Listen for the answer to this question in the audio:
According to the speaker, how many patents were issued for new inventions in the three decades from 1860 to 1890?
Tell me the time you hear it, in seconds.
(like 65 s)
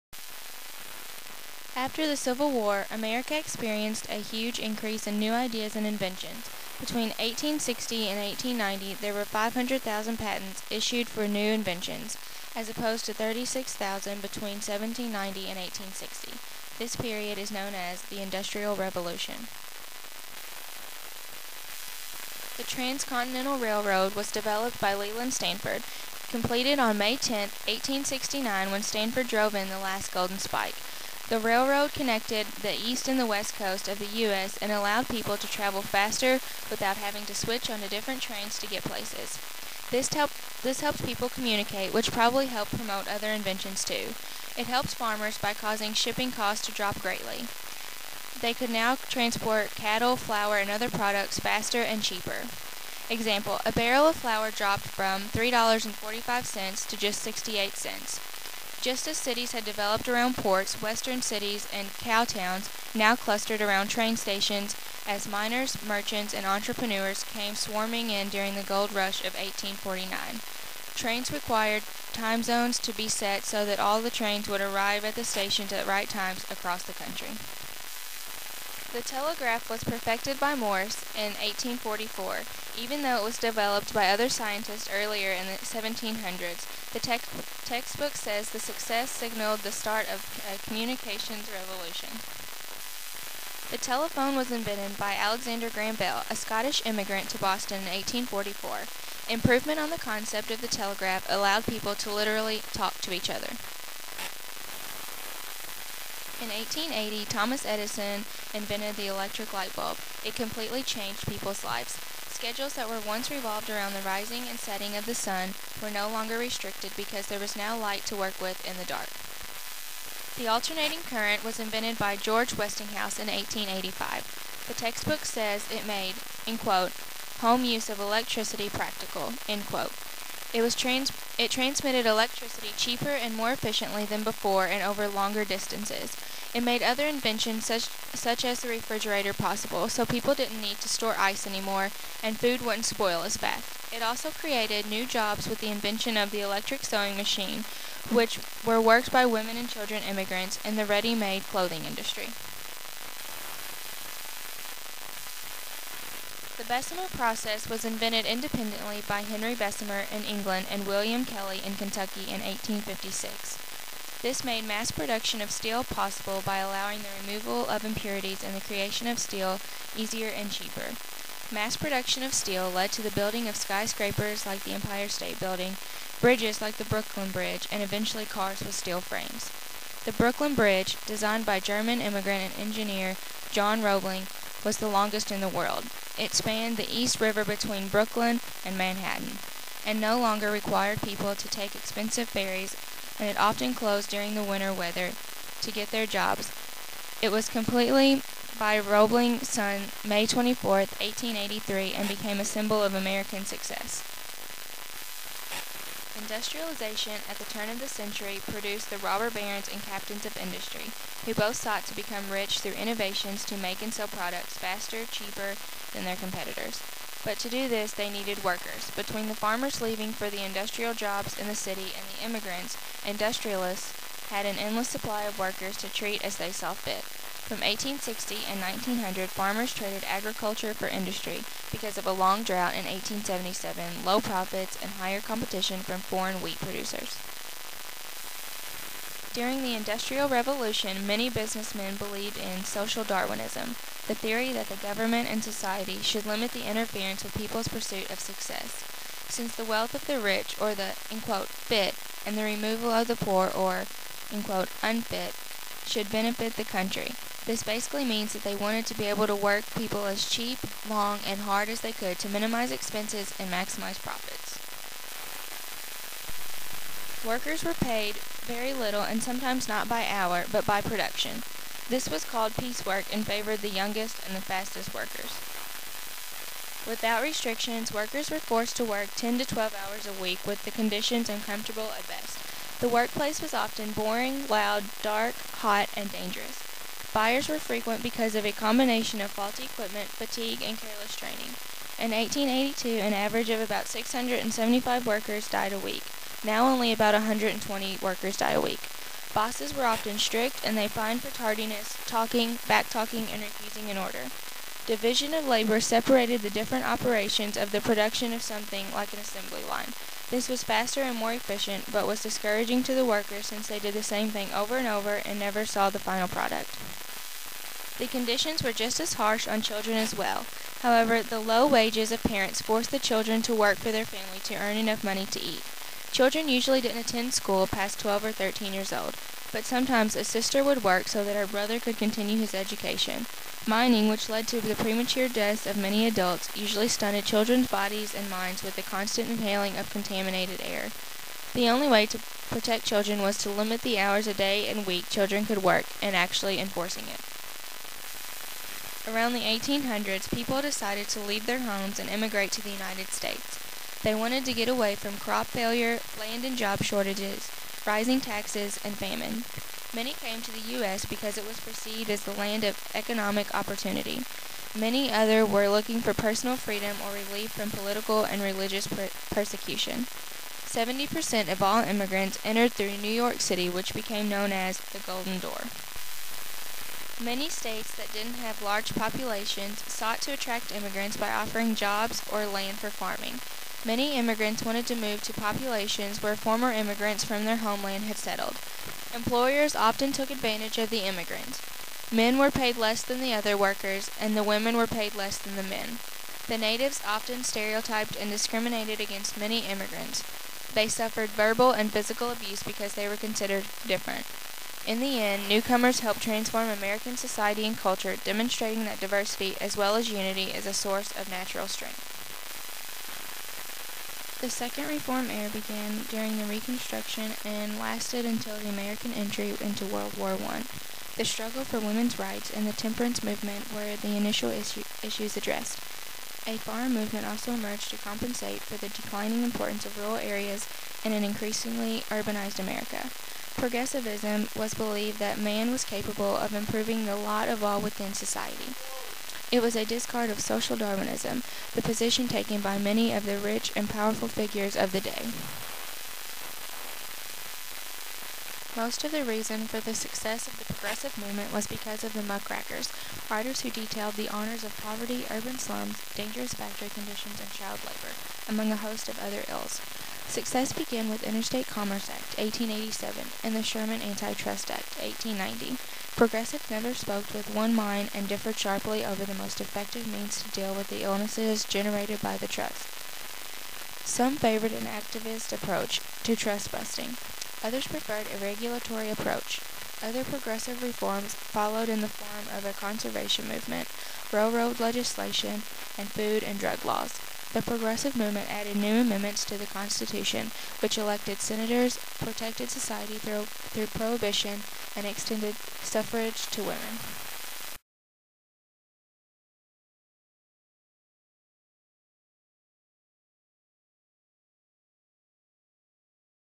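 9 s.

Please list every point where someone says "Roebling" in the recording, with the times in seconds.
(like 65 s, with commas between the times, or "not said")
183 s, 198 s.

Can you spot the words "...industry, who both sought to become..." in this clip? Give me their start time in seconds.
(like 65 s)
210 s.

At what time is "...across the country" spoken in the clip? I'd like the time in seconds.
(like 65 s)
76 s.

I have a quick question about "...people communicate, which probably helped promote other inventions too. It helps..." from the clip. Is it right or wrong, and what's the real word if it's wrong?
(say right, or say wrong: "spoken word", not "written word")
right.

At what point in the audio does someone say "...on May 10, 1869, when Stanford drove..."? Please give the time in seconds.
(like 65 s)
26 s.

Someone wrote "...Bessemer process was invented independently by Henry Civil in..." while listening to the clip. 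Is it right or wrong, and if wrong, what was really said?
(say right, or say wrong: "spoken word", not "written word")
wrong: "Bessemer", not "Civil".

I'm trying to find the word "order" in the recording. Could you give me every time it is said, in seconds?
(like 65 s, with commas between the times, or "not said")
303 s.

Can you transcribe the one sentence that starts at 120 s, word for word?
The alternating current was invented by George Westinghouse in 1885.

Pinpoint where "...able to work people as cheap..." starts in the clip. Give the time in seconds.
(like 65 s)
259 s.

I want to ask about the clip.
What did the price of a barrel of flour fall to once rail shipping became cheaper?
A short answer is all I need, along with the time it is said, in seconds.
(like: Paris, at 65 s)
68 cents, at 57 s.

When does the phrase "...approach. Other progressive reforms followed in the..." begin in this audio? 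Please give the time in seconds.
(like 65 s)
479 s.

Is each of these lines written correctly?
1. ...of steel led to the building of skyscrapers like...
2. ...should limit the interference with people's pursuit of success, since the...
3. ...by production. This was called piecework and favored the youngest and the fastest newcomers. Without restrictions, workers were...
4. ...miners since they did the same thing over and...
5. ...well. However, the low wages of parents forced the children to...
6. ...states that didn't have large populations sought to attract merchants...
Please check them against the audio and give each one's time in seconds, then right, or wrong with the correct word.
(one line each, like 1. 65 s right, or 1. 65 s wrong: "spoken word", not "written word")
1. 172 s right
2. 246 s right
3. 270 s wrong: "workers", not "newcomers"
4. 313 s wrong: "workers", not "miners"
5. 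320 s right
6. 377 s wrong: "immigrants", not "merchants".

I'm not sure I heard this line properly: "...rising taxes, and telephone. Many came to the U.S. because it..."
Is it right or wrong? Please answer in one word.
wrong.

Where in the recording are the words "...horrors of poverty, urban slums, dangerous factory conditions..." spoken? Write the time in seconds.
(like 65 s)
454 s.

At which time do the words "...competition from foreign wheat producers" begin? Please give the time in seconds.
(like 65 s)
235 s.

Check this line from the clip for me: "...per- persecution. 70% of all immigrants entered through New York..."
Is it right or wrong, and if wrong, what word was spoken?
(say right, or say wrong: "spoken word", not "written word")
right.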